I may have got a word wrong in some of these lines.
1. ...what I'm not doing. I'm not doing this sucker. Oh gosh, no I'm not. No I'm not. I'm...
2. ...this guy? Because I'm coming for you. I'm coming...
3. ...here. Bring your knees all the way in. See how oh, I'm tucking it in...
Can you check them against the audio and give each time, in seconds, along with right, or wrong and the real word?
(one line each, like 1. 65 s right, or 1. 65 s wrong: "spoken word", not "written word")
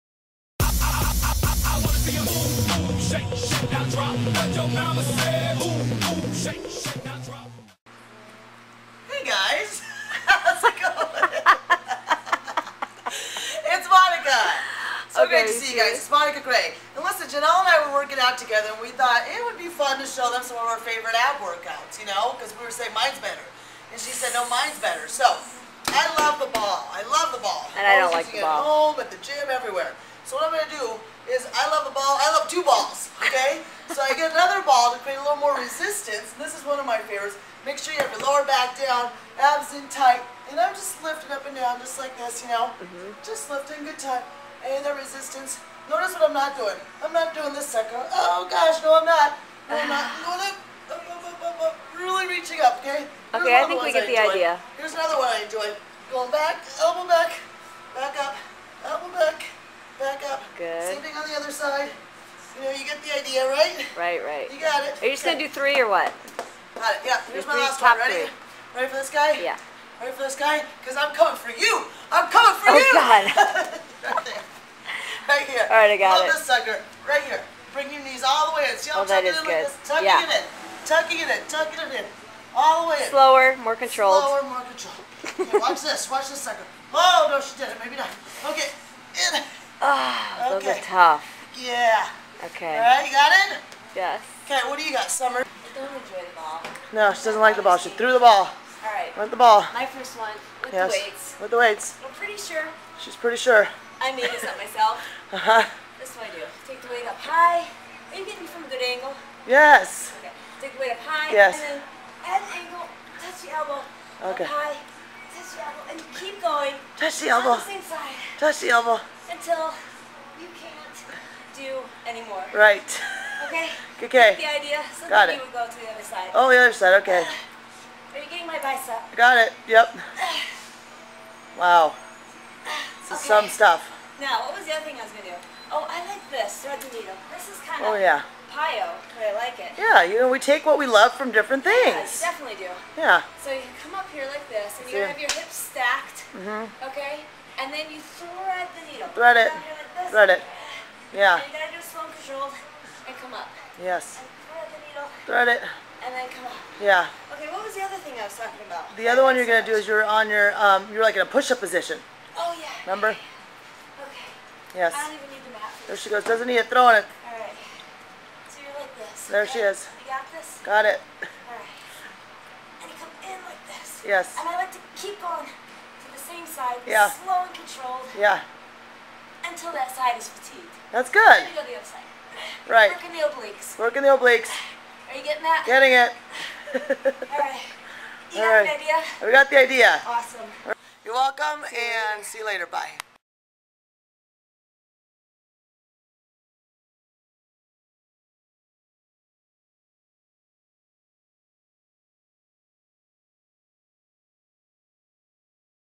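1. 46 s right
2. 70 s right
3. 77 s right.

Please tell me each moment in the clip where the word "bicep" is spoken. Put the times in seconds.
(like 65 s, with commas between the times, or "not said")
128 s.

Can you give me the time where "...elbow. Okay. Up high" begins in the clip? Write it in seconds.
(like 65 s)
113 s.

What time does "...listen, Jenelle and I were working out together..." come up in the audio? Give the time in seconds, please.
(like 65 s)
17 s.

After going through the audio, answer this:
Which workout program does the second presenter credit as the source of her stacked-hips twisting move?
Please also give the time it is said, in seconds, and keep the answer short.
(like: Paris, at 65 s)
PiYo, at 138 s.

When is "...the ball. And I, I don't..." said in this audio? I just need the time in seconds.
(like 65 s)
27 s.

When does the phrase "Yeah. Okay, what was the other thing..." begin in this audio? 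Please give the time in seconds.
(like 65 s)
156 s.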